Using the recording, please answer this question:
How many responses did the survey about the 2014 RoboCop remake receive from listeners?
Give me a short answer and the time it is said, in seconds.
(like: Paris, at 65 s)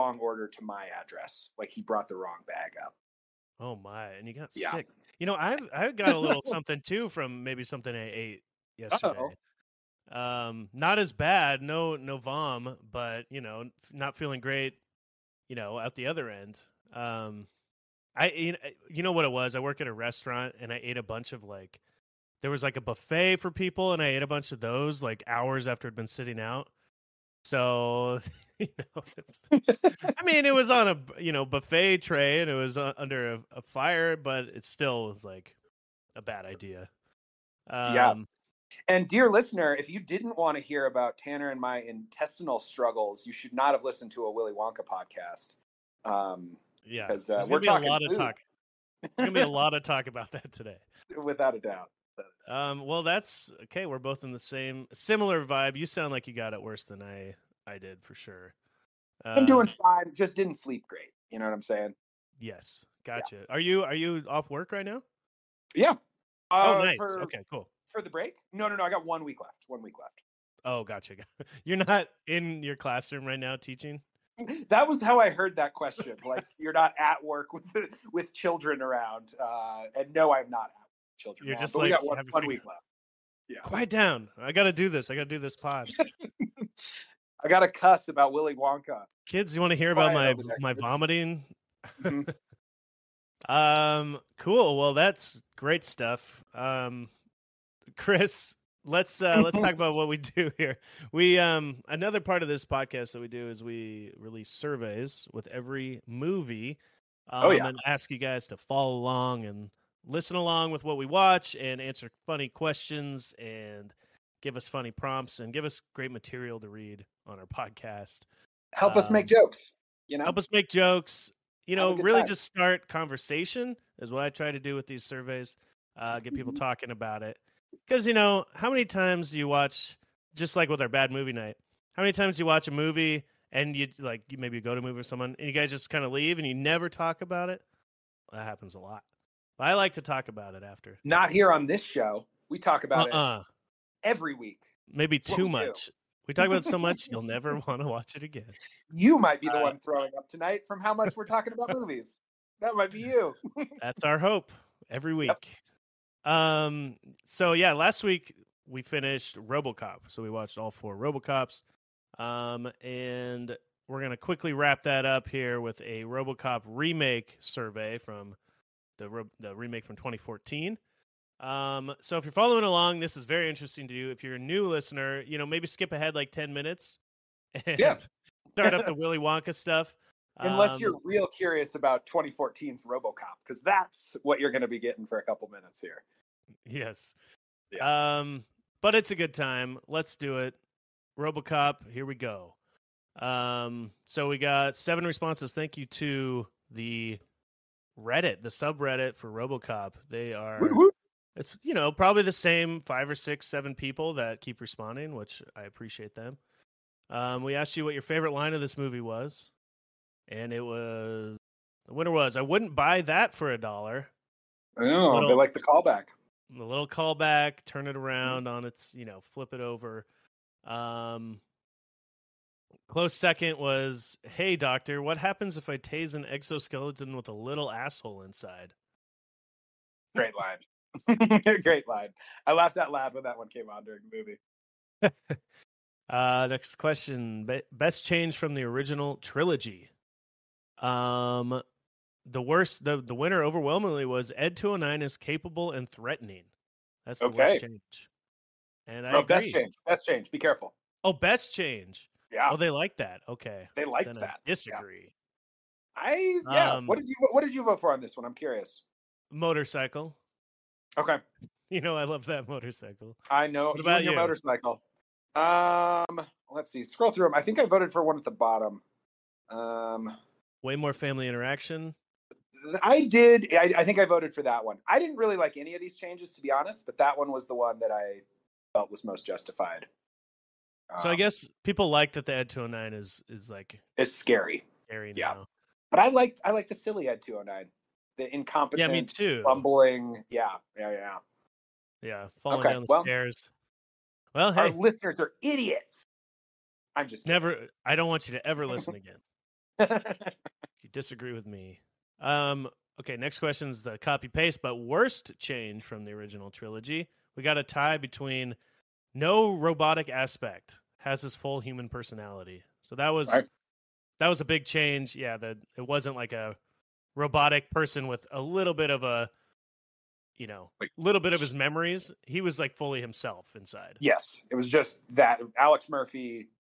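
7, at 194 s.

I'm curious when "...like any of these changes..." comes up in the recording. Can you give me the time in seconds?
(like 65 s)
275 s.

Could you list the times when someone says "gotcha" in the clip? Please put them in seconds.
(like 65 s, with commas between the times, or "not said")
63 s, 70 s.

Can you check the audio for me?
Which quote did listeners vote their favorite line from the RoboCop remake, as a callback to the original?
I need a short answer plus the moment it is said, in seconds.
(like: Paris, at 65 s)
I wouldn't buy that for a dollar, at 212 s.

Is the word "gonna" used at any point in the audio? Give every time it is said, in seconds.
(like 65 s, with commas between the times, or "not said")
49 s, 164 s.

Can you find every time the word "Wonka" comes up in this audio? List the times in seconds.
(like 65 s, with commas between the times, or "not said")
44 s, 88 s, 179 s.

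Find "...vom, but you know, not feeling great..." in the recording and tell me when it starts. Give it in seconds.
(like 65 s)
12 s.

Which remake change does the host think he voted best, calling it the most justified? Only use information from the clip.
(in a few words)
way more family interaction.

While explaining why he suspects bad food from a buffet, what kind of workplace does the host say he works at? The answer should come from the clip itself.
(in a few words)
a restaurant.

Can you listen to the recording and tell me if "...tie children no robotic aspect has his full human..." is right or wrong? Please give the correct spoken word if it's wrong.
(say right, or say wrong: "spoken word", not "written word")
wrong: "between", not "children".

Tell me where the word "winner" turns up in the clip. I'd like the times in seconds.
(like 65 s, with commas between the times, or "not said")
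211 s, 243 s.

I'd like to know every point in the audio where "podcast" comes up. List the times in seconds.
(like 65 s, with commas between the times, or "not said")
44 s, 102 s, 117 s.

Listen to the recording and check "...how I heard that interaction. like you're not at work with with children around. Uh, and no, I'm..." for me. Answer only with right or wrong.
wrong.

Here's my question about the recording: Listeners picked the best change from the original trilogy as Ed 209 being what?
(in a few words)
capable and threatening.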